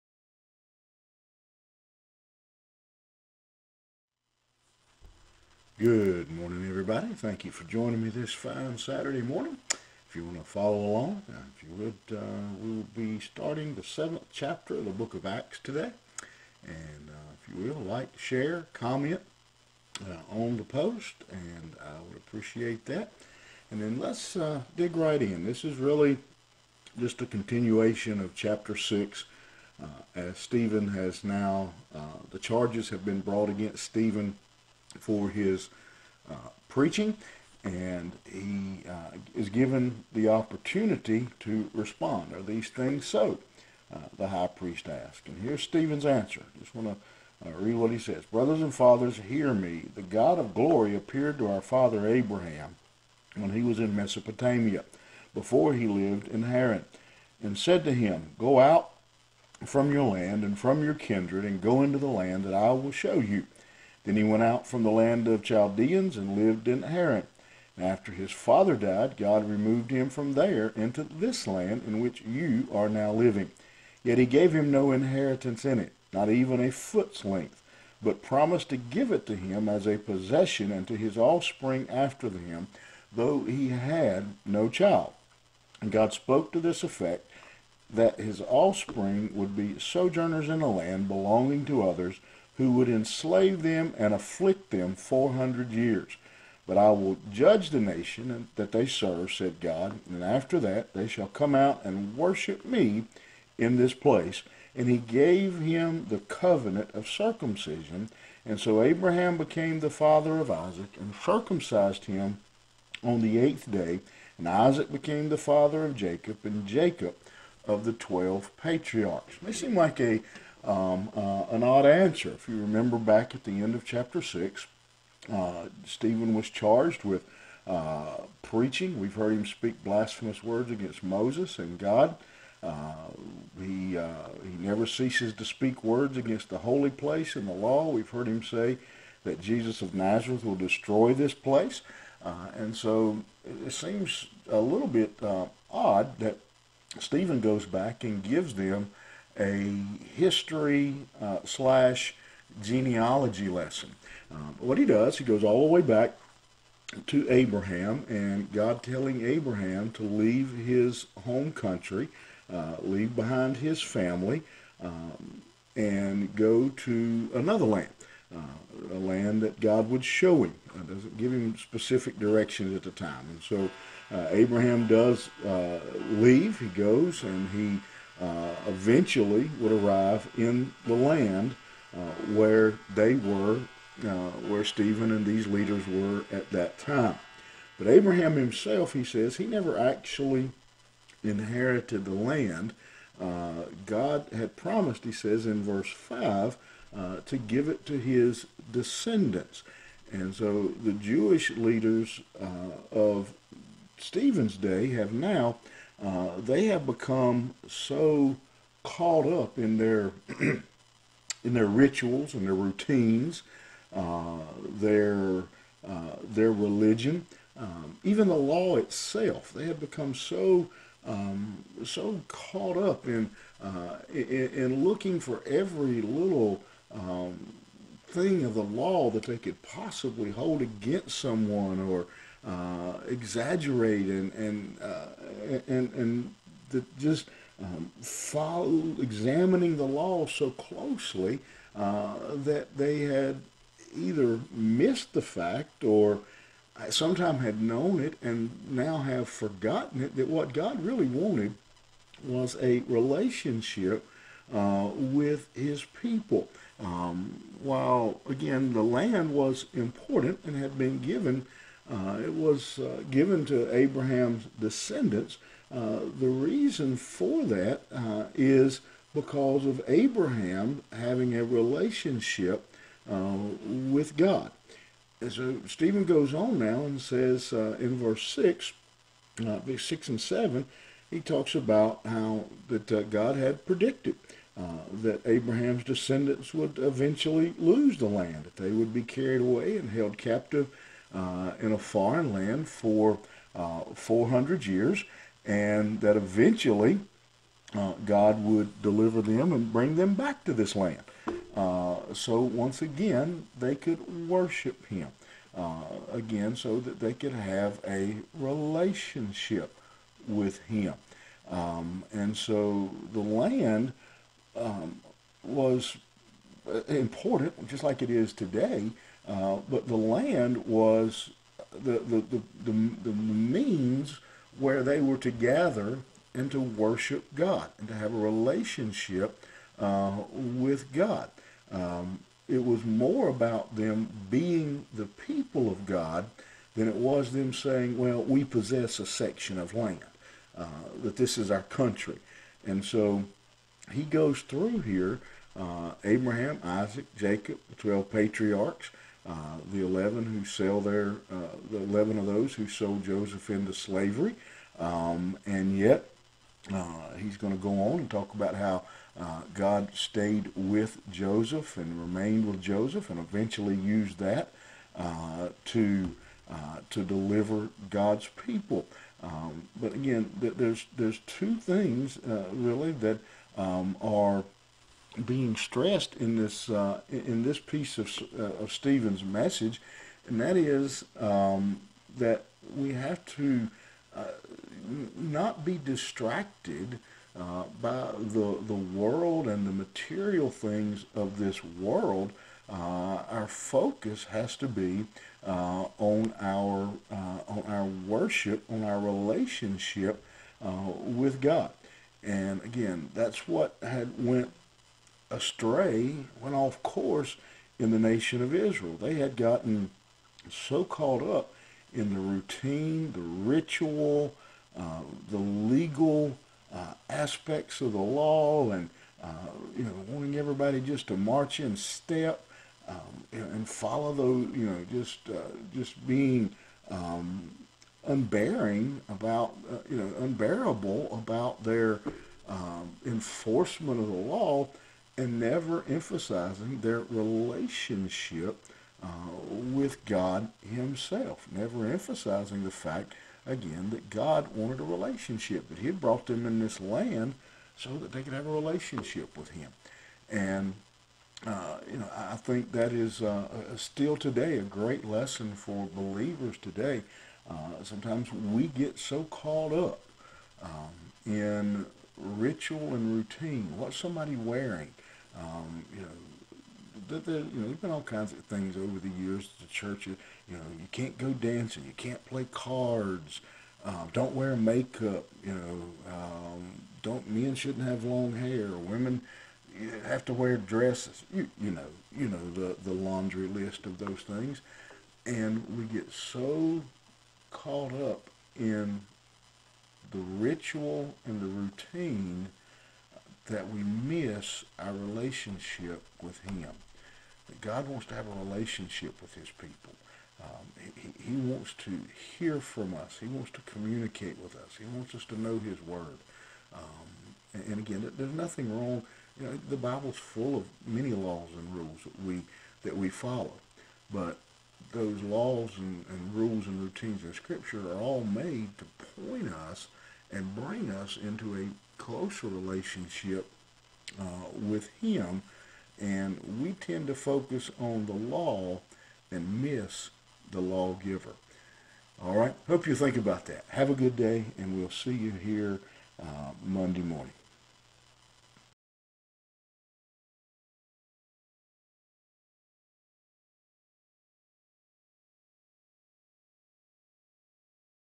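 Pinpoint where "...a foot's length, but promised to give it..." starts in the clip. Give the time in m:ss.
1:16.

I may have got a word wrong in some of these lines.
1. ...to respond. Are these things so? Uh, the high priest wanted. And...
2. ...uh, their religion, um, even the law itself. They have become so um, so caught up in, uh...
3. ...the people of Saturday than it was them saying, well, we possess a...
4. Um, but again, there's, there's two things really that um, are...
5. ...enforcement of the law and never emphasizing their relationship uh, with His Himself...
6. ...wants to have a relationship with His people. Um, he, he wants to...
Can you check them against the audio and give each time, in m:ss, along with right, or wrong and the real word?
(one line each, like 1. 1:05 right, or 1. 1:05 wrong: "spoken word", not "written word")
1. 0:41 wrong: "asked", not "wanted"
2. 3:35 right
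3. 5:34 wrong: "God", not "Saturday"
4. 6:09 right
5. 7:13 wrong: "God", not "His"
6. 8:17 right.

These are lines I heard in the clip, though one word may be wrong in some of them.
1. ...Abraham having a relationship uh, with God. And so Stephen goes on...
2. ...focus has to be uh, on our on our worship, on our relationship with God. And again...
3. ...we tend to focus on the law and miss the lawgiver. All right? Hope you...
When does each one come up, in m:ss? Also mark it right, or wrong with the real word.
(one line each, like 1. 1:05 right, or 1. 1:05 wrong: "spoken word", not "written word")
1. 4:29 right
2. 6:33 right
3. 8:46 right.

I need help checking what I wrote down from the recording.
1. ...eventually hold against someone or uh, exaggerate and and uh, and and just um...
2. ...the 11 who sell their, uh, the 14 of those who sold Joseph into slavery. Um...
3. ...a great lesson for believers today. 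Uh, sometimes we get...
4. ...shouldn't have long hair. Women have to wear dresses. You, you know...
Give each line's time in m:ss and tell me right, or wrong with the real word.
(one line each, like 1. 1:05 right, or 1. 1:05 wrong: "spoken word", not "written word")
1. 3:49 wrong: "possibly", not "eventually"
2. 5:49 wrong: "11", not "14"
3. 7:34 right
4. 7:57 right.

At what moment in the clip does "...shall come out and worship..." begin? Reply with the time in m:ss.
1:41.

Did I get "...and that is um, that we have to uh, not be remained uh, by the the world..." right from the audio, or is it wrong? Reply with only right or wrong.
wrong.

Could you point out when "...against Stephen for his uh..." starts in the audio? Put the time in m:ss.
0:33.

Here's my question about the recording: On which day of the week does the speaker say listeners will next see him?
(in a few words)
Monday.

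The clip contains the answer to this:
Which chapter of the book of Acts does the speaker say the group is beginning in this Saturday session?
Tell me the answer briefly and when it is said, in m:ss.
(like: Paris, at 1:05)
seventh, at 0:13.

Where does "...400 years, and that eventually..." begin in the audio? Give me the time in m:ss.
4:53.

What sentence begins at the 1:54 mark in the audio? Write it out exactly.
And Isaac became the father of Jacob and Jacob of the twelve patriarchs.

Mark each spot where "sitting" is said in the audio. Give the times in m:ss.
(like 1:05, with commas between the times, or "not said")
not said.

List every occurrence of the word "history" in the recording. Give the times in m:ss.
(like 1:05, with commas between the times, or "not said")
2:30.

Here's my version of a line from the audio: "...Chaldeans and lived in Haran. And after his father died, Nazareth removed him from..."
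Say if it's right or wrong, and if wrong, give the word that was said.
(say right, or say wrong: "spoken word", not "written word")
wrong: "God", not "Nazareth".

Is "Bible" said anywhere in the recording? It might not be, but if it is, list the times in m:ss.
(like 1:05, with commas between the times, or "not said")
8:29.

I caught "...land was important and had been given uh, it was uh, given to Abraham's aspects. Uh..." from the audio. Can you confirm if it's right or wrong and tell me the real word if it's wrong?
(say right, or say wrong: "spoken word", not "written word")
wrong: "descendants", not "aspects".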